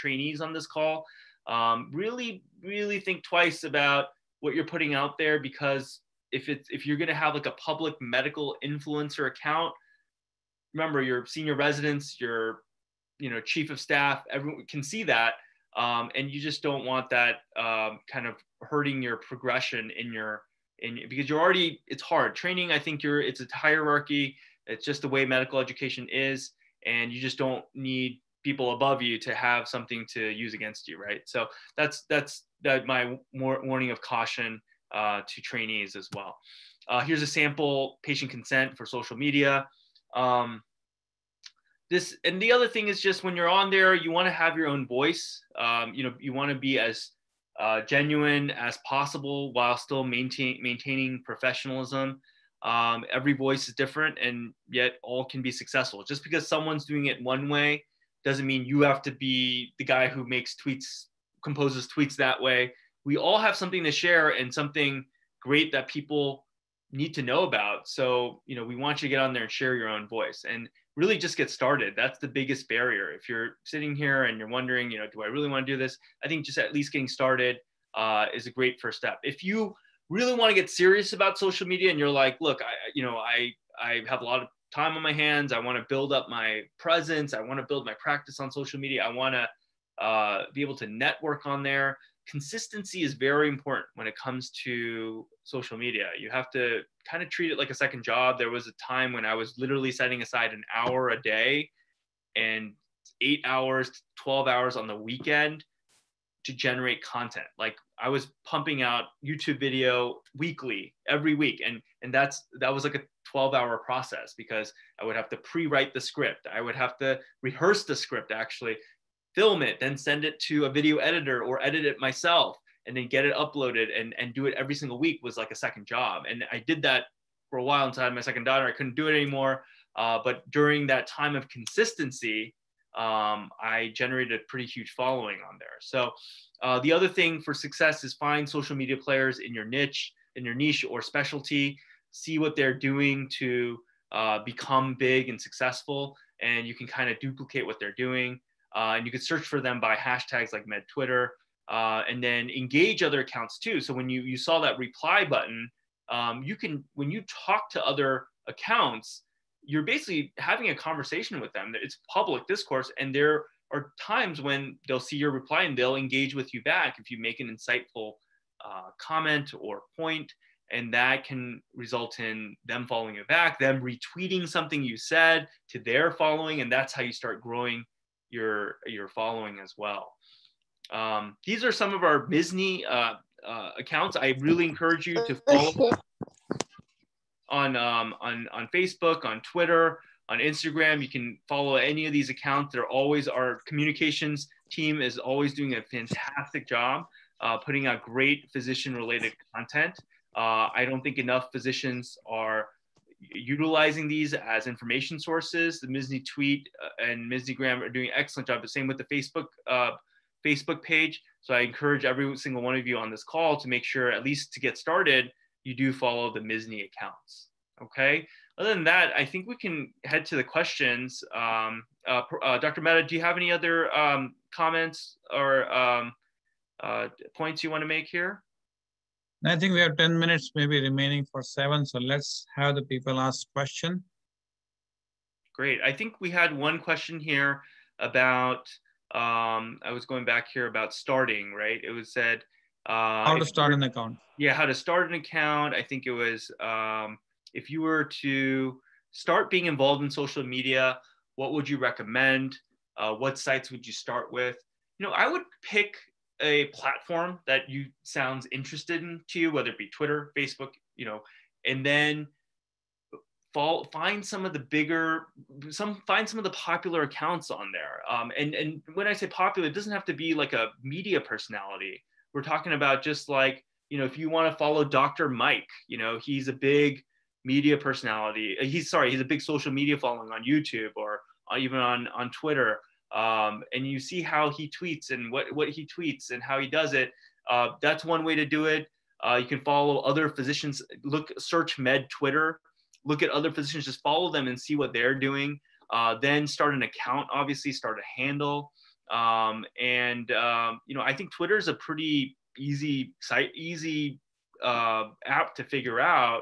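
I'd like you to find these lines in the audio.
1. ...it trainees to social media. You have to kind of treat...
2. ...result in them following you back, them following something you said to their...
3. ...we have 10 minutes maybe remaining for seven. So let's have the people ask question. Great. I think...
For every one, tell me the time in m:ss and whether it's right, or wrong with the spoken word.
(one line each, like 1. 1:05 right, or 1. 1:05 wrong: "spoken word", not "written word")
1. 1:34 wrong: "comes", not "trainees"
2. 2:51 wrong: "retweeting", not "following"
3. 3:49 right.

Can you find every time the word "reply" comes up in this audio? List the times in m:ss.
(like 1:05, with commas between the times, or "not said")
2:34, 2:45.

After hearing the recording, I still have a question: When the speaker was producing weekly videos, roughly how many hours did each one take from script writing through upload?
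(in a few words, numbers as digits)
12 hours.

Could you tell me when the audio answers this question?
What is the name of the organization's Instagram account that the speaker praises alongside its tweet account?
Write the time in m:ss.
3:27.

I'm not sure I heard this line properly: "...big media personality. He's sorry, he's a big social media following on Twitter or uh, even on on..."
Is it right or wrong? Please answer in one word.
wrong.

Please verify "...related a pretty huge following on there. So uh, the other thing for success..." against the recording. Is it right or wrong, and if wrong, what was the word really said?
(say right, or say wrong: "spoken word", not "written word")
wrong: "generated", not "related".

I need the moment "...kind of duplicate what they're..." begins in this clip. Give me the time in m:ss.
2:26.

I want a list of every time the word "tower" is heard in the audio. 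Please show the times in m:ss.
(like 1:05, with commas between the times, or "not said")
not said.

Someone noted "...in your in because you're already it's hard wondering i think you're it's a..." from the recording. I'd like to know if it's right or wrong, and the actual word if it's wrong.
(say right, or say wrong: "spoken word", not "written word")
wrong: "training", not "wondering".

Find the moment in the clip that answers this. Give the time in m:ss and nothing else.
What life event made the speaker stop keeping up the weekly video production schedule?
2:08.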